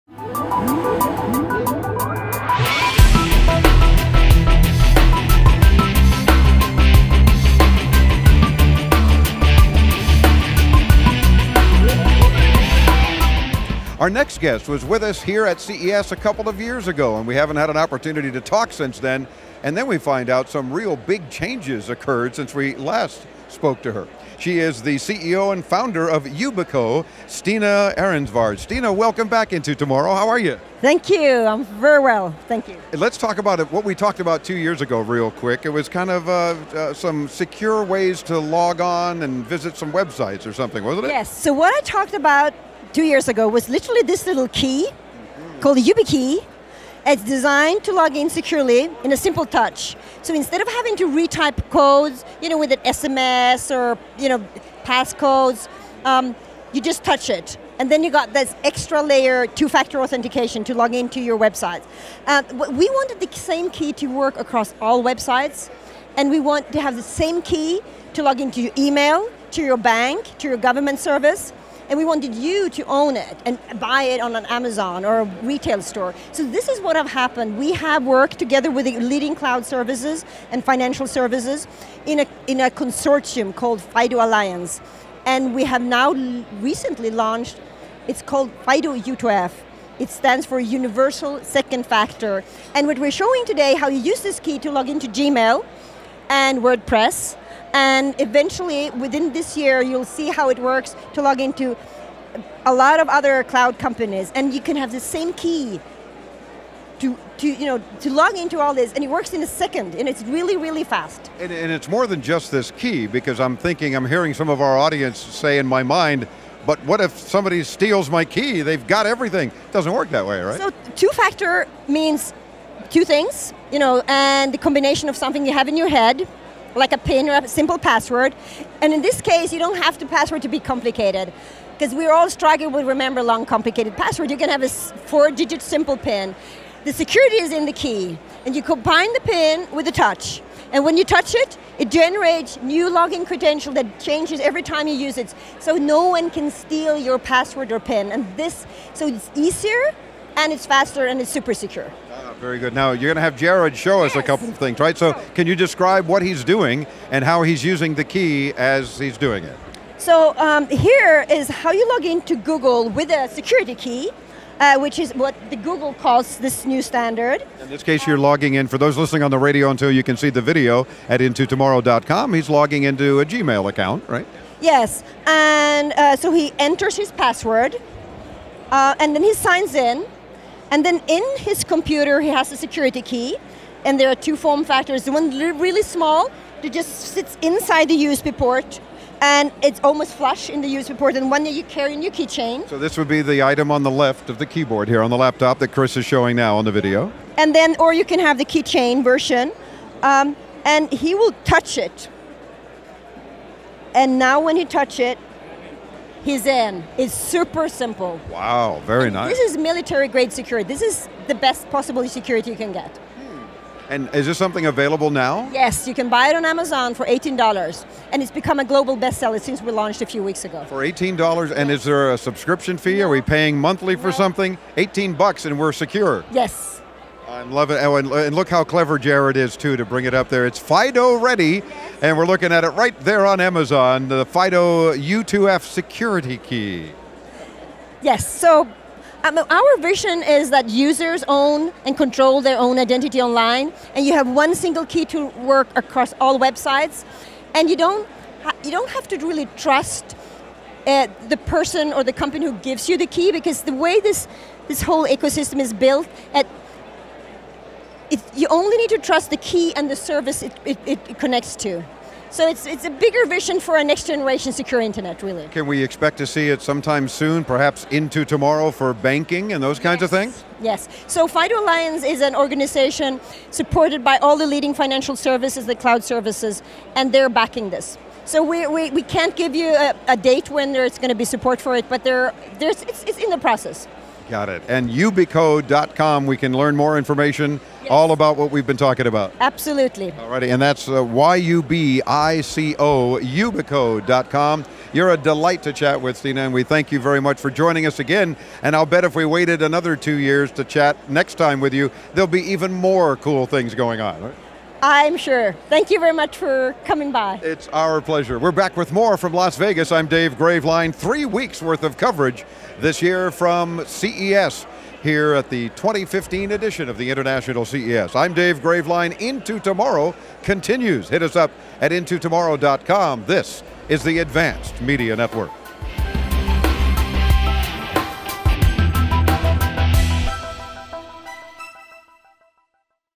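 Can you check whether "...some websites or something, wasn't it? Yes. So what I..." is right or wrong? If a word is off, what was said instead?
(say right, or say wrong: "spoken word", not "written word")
right.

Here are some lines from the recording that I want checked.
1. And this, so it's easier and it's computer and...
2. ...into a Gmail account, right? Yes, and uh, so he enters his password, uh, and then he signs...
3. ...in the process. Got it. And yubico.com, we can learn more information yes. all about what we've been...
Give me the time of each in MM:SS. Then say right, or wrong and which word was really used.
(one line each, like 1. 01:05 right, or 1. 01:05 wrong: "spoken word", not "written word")
1. 02:28 wrong: "faster", not "computer"
2. 02:52 right
3. 04:43 right.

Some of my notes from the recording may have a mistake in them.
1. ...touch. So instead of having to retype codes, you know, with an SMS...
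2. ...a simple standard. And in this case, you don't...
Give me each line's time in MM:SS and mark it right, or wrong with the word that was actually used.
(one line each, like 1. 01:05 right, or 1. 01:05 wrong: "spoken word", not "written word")
1. 00:49 right
2. 02:07 wrong: "password", not "standard".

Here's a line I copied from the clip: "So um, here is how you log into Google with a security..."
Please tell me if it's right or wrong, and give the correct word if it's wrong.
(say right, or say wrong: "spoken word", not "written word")
right.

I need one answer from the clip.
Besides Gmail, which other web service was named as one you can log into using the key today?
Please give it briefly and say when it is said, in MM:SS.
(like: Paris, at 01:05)
WordPress, at 01:36.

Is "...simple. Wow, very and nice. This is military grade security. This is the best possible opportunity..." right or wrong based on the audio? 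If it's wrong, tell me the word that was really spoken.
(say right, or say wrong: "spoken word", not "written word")
wrong: "security", not "opportunity".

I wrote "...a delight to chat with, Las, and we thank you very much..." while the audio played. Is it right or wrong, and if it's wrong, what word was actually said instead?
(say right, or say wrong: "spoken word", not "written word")
wrong: "Stina", not "Las".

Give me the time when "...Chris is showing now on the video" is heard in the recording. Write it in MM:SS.
03:15.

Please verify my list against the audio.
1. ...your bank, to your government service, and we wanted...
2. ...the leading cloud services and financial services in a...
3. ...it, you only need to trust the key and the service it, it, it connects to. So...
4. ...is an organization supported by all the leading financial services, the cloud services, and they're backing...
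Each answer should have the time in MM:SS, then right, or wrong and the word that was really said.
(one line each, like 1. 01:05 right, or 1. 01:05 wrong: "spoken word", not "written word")
1. 01:09 right
2. 01:18 right
3. 04:18 right
4. 04:32 right.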